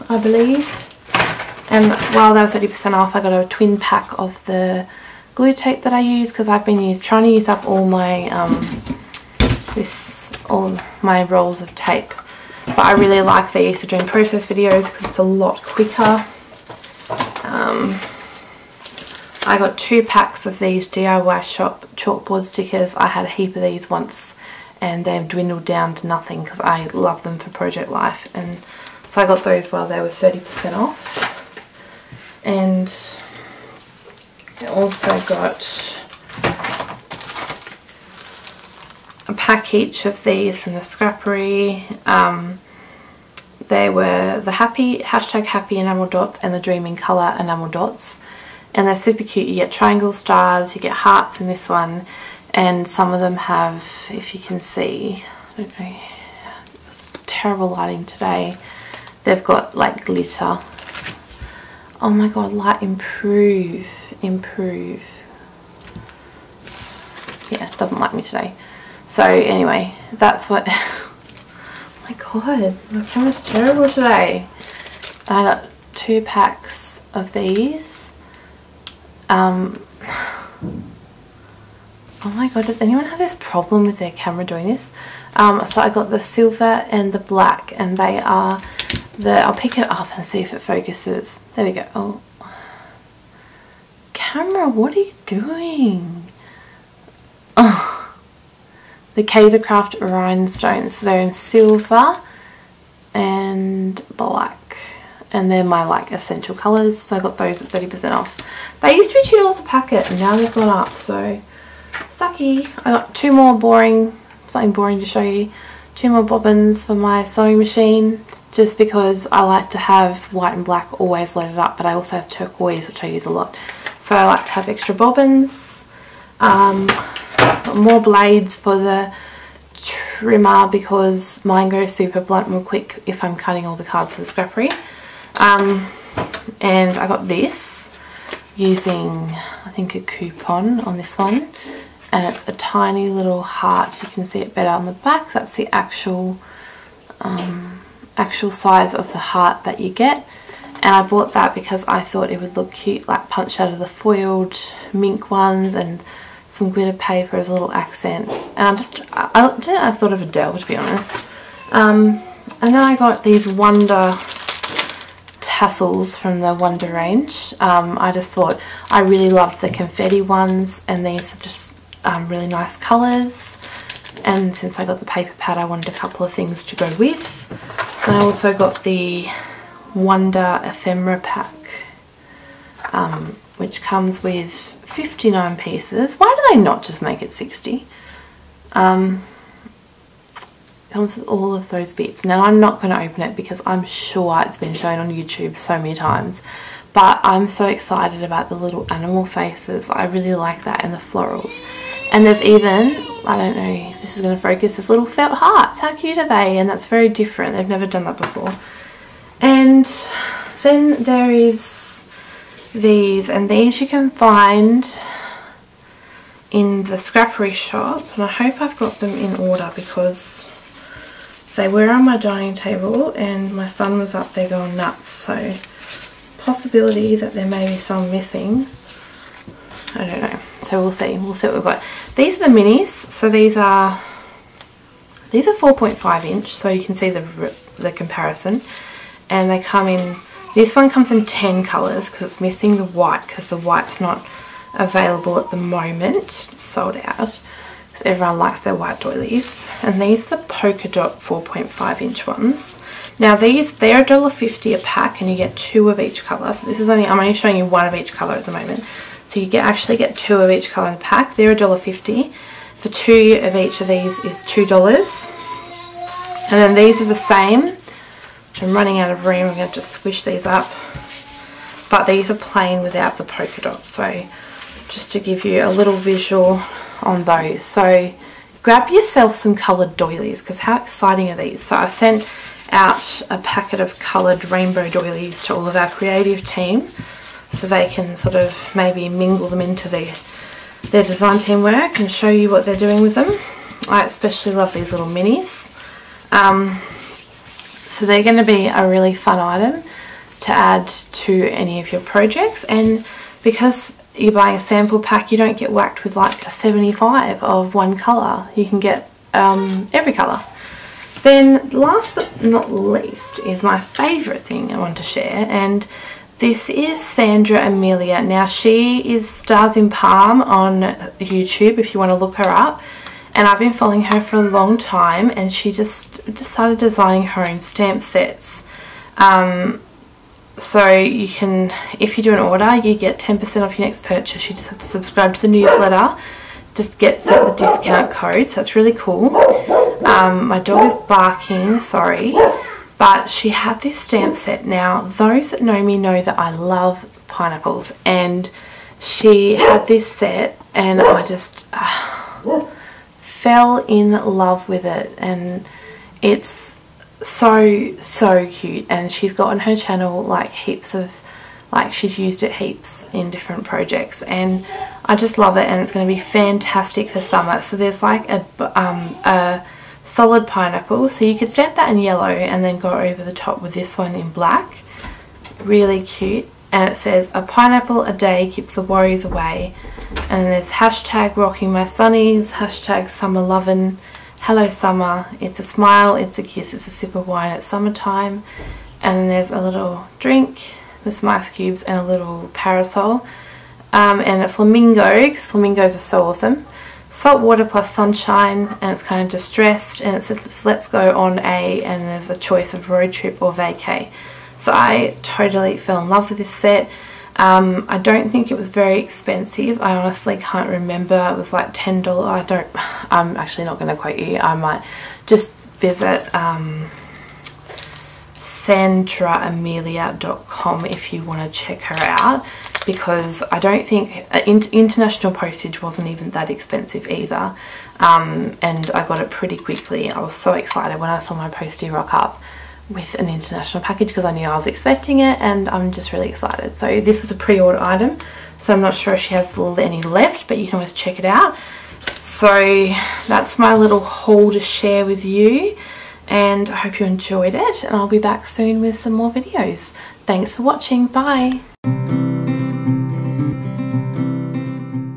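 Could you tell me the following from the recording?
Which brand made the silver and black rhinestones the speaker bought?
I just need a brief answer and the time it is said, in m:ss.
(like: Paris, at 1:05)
Kaisercraft, at 1:39.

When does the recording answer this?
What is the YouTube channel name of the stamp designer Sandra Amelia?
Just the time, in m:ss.
5:19.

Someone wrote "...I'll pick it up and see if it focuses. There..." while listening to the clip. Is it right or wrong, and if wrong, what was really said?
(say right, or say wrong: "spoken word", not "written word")
right.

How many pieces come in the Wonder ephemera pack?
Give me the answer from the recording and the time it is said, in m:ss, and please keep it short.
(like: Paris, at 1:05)
59, at 3:04.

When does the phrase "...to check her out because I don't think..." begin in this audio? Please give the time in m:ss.
7:01.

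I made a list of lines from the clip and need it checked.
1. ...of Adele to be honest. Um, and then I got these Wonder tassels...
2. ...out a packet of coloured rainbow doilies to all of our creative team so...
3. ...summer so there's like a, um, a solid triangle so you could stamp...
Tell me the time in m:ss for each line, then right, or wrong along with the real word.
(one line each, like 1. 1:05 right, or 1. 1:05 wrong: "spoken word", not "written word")
1. 2:40 right
2. 4:42 right
3. 6:07 wrong: "pineapple", not "triangle".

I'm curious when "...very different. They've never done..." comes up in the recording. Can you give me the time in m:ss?
3:26.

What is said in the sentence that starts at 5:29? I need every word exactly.
Um, so you can, if you do an order, you get 10% off your next purchase.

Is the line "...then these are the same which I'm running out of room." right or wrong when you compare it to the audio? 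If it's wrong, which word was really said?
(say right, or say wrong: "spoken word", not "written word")
right.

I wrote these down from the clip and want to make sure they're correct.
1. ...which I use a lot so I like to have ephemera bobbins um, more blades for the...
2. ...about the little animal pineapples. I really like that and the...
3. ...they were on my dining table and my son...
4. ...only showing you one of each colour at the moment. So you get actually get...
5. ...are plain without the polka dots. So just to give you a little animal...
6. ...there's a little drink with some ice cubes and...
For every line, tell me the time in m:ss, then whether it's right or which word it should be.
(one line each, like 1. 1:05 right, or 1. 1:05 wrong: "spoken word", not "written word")
1. 2:02 wrong: "extra", not "ephemera"
2. 3:18 wrong: "faces", not "pineapples"
3. 3:41 right
4. 4:17 right
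5. 4:32 wrong: "visual", not "animal"
6. 6:29 right.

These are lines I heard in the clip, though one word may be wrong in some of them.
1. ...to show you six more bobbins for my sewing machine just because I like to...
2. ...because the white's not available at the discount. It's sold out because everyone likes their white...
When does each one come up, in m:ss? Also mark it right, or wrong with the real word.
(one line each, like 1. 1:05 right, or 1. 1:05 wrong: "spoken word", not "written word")
1. 1:54 wrong: "two", not "six"
2. 4:03 wrong: "moment", not "discount".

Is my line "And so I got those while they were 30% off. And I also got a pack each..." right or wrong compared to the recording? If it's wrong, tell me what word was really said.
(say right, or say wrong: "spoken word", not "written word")
right.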